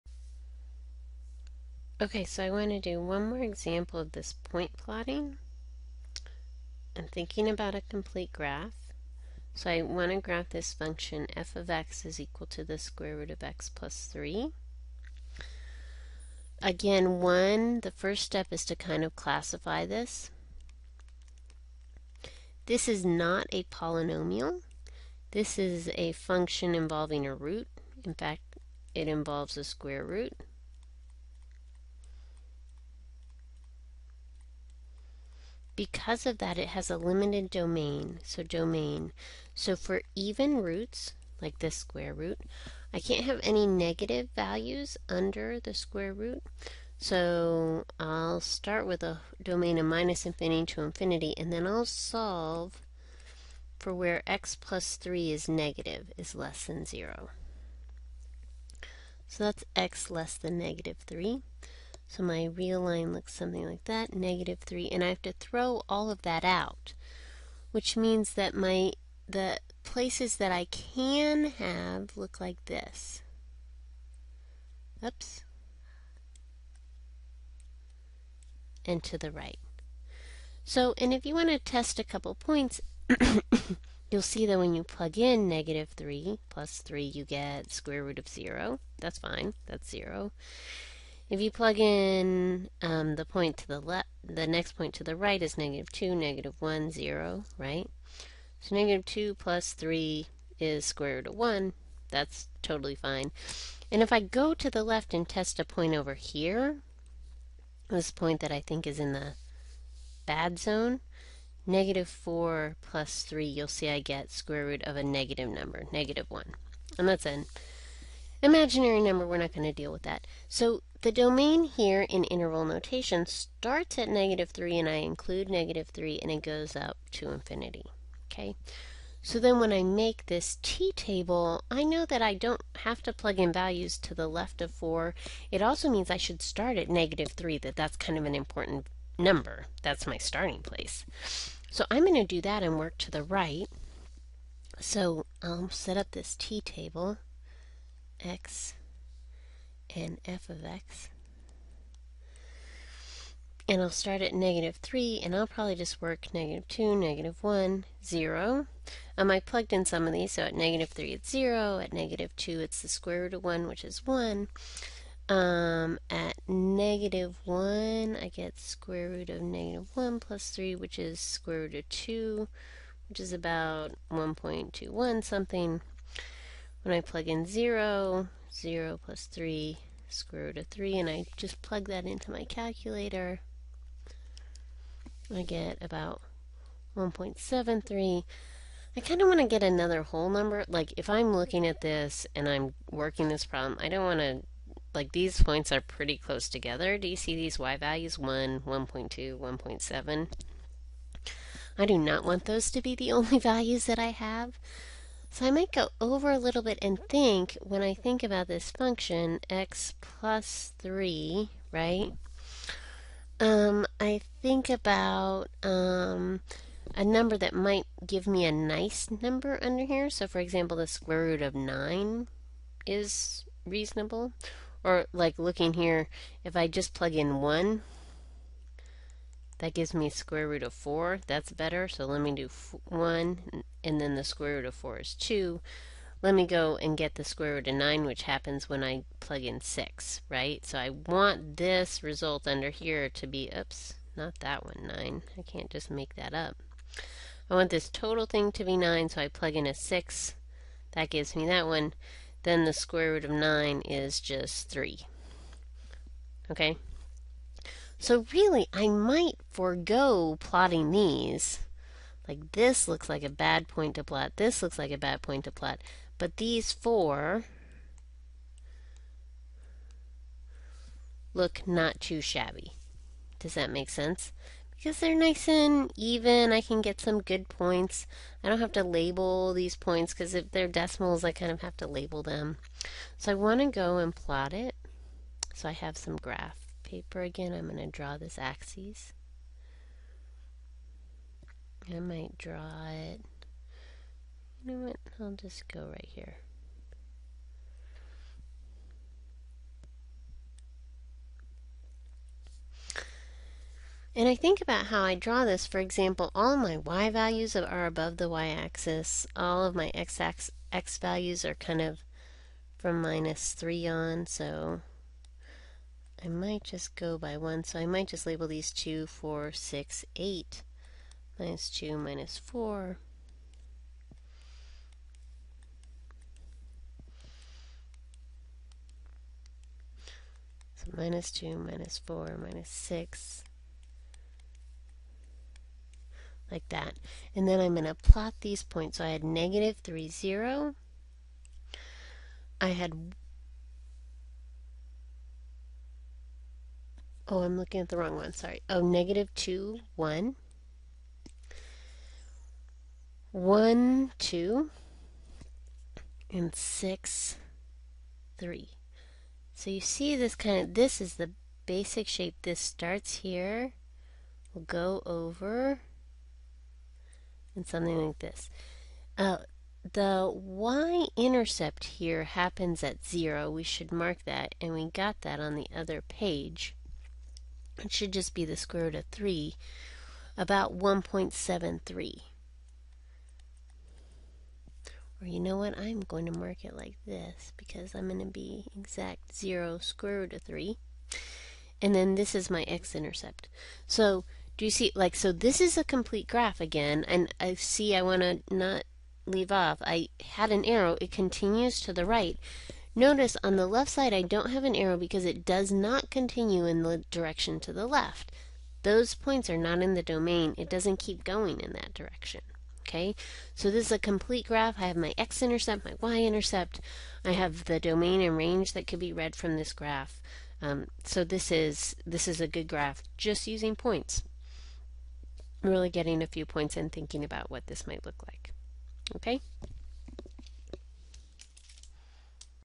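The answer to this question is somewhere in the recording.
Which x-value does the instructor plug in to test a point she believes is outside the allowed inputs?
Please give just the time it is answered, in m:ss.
1:51.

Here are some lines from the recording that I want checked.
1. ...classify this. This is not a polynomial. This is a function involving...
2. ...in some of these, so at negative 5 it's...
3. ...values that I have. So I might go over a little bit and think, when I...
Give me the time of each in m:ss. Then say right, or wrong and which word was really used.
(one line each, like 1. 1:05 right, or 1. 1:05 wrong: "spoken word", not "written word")
1. 0:19 right
2. 2:39 wrong: "3", not "5"
3. 3:23 right.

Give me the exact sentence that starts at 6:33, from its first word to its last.
So do you see, like, so this is a complete graph again.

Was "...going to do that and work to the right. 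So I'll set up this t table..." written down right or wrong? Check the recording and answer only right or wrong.
right.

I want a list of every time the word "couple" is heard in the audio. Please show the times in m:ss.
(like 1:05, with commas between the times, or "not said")
1:22.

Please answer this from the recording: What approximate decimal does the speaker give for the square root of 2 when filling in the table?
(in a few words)
1.21.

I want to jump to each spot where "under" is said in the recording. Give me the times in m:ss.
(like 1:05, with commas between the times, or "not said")
0:45, 3:39, 4:02.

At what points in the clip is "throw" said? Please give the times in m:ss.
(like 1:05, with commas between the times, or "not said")
1:05.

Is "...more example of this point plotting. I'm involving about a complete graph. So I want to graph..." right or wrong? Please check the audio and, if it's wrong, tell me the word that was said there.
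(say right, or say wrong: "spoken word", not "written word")
wrong: "thinking", not "involving".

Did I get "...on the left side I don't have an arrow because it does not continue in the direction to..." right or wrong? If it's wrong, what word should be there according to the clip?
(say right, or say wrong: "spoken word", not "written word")
right.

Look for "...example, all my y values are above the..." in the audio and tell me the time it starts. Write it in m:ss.
5:05.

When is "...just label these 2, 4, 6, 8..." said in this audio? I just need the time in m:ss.
5:18.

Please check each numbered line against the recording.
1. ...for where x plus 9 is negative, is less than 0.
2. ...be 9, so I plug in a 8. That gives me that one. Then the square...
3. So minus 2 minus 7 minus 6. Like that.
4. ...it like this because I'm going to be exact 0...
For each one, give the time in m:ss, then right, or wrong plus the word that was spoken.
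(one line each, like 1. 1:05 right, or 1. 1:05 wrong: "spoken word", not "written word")
1. 0:53 wrong: "3", not "9"
2. 4:08 wrong: "6", not "8"
3. 5:30 wrong: "4", not "7"
4. 6:26 right.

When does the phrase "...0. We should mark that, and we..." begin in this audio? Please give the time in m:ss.
6:13.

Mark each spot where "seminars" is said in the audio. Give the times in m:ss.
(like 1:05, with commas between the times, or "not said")
not said.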